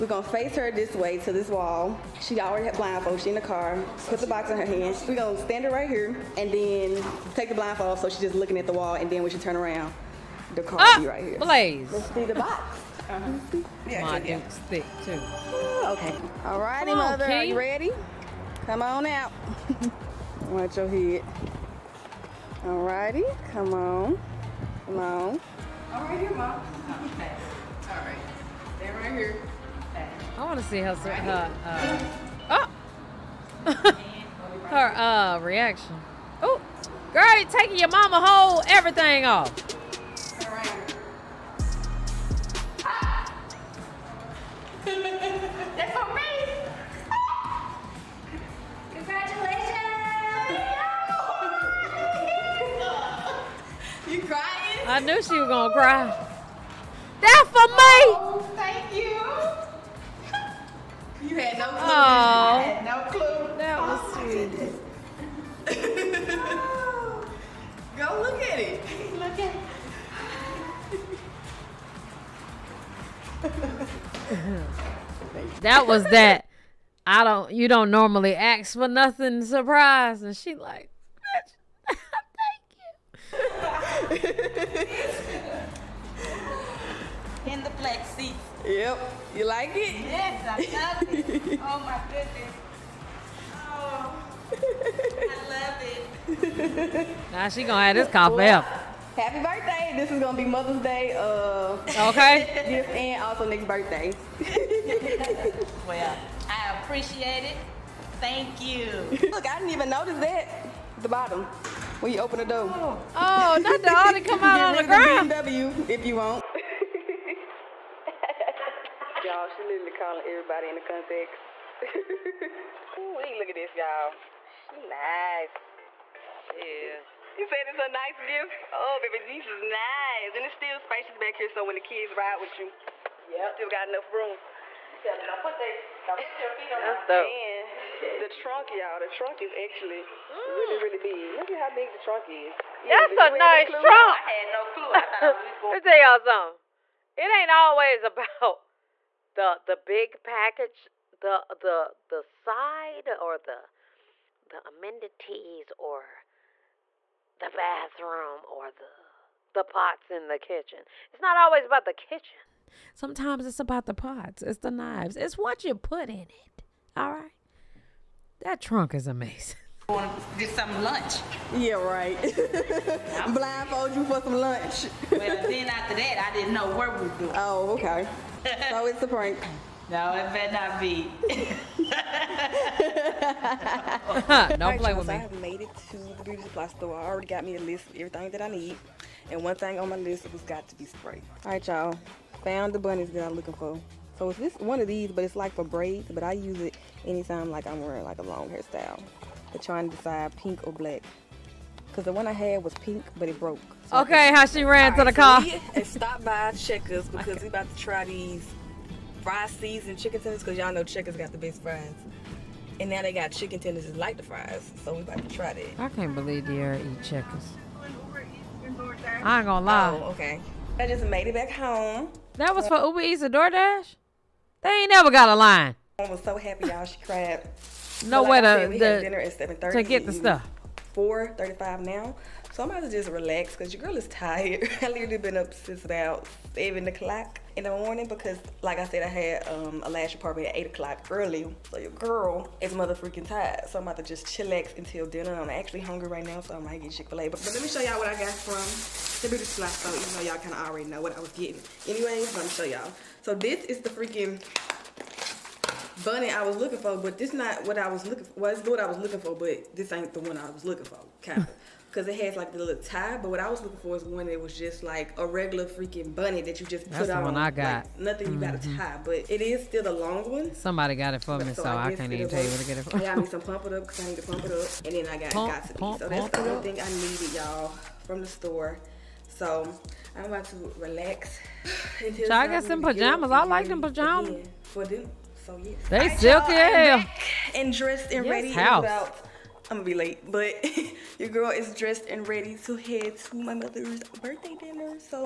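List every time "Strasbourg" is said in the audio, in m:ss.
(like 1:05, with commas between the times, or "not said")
not said.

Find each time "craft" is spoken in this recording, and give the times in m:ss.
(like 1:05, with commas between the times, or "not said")
not said.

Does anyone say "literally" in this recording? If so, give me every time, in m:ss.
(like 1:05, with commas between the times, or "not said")
1:59, 3:54.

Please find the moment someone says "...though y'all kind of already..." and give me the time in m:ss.
4:10.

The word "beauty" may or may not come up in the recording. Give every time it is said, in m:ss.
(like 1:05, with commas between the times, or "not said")
3:06, 4:09.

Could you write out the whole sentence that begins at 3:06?
I already got me a list of everything that I need.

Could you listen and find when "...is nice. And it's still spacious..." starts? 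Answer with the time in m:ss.
2:09.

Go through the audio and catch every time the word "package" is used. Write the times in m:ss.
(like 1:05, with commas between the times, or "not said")
2:30.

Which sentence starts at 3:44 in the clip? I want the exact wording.
They ain't never got a line.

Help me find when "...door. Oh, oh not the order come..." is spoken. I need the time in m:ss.
1:52.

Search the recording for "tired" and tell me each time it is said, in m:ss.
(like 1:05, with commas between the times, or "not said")
3:54, 4:03.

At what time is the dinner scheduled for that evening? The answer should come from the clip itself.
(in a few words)
7:30.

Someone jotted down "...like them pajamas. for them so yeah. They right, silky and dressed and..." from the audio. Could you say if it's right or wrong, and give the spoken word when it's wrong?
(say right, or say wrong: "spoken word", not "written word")
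right.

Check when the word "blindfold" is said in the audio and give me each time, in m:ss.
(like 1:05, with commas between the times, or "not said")
0:02, 0:07, 2:53.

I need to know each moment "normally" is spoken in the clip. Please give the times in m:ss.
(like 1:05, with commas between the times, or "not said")
1:17.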